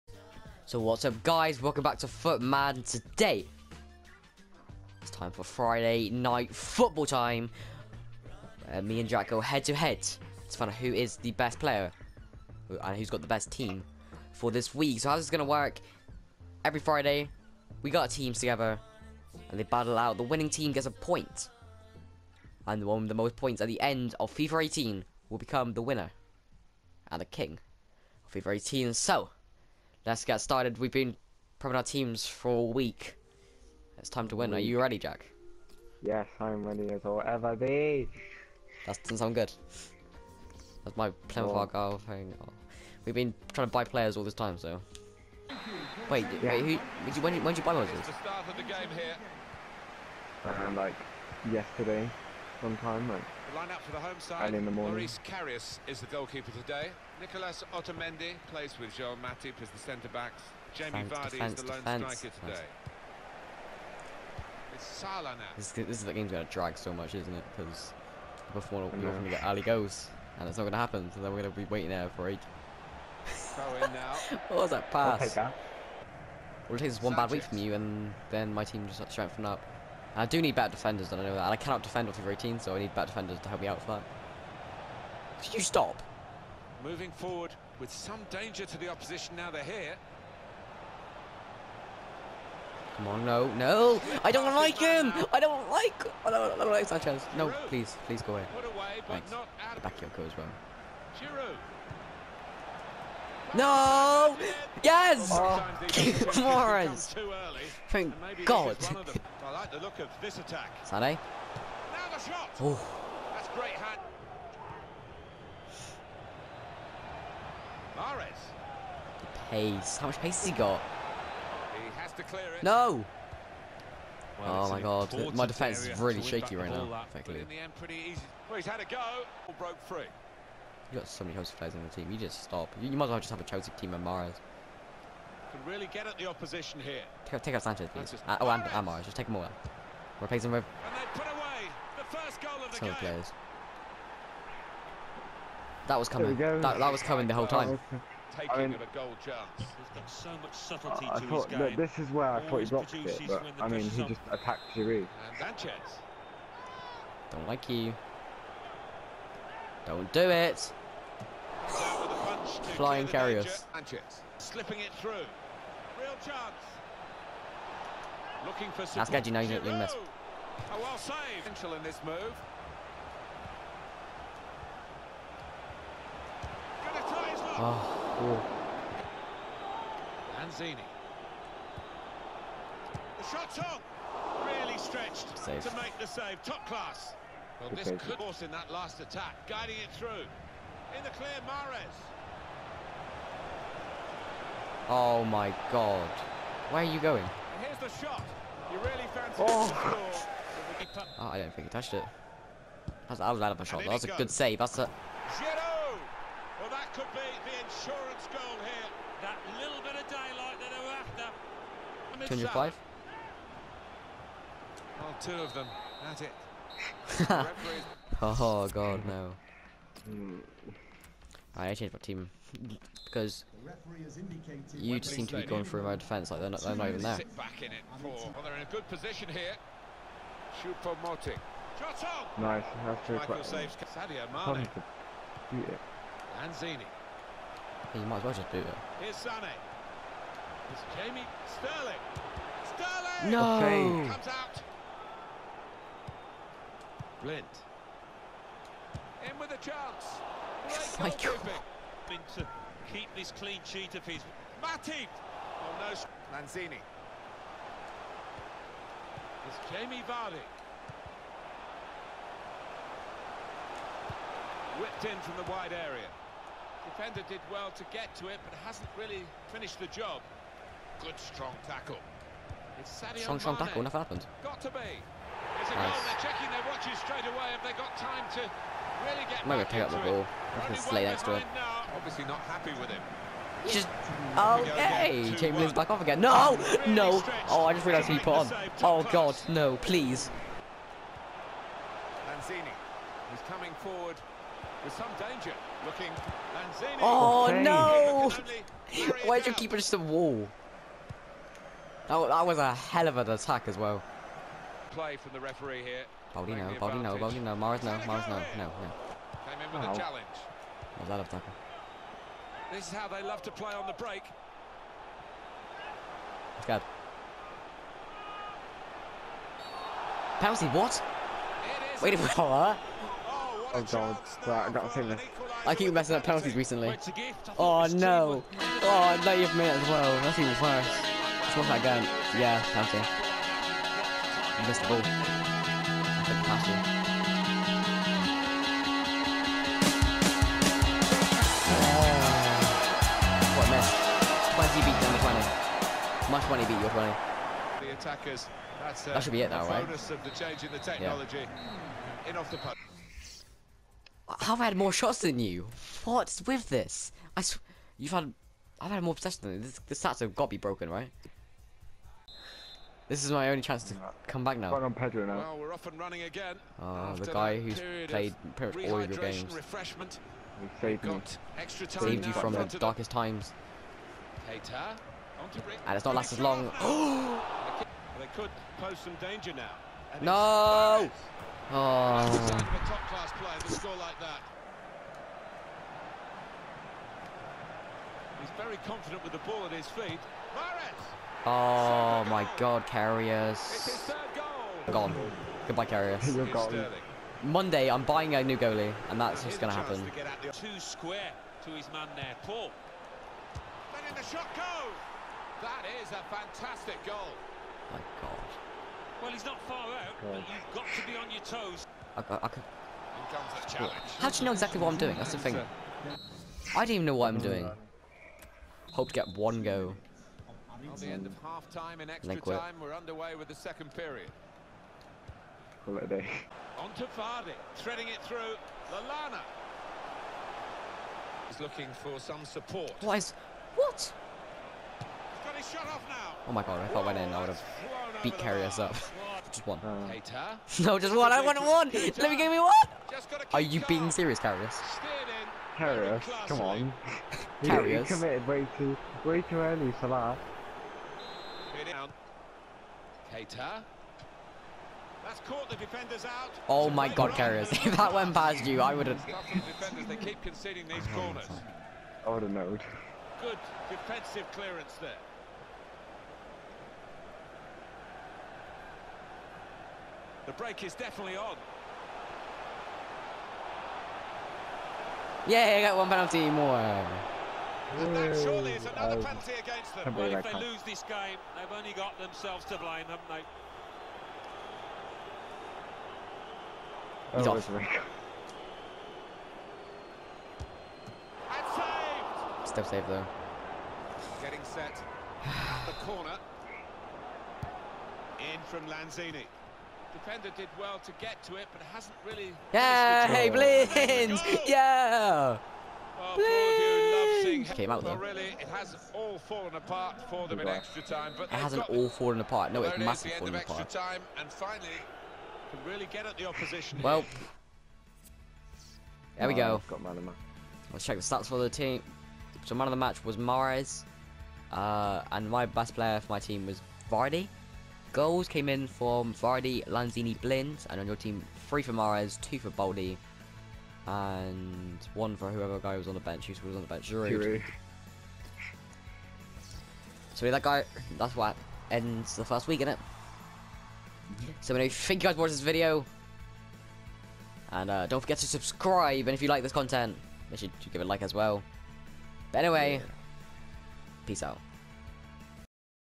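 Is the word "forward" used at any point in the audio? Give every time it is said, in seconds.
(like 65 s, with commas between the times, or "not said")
87 s, 293 s.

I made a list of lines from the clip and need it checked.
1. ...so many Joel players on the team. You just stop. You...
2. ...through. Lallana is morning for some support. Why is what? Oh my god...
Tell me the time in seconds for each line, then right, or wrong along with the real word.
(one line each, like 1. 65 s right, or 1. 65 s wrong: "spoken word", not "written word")
1. 131 s wrong: "Chelsea", not "Joel"
2. 428 s wrong: "looking", not "morning".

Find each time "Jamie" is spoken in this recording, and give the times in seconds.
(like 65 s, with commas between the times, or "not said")
60 s, 240 s, 259 s.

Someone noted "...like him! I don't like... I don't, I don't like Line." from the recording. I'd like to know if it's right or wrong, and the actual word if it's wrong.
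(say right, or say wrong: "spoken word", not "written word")
wrong: "Sanchez", not "Line".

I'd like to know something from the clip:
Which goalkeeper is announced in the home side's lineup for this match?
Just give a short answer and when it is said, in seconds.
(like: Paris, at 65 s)
Loris Karius, at 54 s.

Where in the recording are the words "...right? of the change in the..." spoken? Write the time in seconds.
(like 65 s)
349 s.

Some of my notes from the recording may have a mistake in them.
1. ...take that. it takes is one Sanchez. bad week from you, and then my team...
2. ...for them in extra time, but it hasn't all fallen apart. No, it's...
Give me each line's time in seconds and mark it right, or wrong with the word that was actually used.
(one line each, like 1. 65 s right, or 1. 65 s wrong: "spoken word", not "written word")
1. 75 s right
2. 510 s right.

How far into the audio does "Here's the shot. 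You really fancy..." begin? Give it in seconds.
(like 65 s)
197 s.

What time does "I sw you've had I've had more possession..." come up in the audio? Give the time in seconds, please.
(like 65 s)
357 s.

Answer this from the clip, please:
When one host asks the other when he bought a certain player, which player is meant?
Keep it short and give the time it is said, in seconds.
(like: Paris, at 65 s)
Moses, at 47 s.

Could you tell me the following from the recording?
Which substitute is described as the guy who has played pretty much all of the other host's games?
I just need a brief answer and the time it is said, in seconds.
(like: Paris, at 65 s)
Pedro, at 364 s.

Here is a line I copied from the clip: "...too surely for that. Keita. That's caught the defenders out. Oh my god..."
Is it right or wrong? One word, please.
wrong.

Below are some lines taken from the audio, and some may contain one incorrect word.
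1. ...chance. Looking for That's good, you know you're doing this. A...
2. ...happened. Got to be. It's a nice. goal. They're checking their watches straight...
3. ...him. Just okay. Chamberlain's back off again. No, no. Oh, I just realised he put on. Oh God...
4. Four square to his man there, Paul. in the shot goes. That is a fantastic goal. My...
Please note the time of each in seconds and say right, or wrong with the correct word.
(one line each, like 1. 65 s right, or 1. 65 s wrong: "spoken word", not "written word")
1. 166 s right
2. 274 s right
3. 282 s right
4. 400 s wrong: "Two", not "Four".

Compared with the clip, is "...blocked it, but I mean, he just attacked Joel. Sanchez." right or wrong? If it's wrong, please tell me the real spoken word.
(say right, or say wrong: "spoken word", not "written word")
wrong: "Giroud", not "Joel".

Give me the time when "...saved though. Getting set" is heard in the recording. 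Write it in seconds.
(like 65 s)
492 s.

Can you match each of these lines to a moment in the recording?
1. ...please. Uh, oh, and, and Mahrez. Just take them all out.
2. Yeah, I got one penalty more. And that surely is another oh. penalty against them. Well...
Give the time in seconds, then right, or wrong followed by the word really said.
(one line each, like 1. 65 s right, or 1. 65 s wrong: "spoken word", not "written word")
1. 137 s right
2. 475 s right.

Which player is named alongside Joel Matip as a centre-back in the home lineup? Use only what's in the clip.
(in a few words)
Nicolas Otamendi.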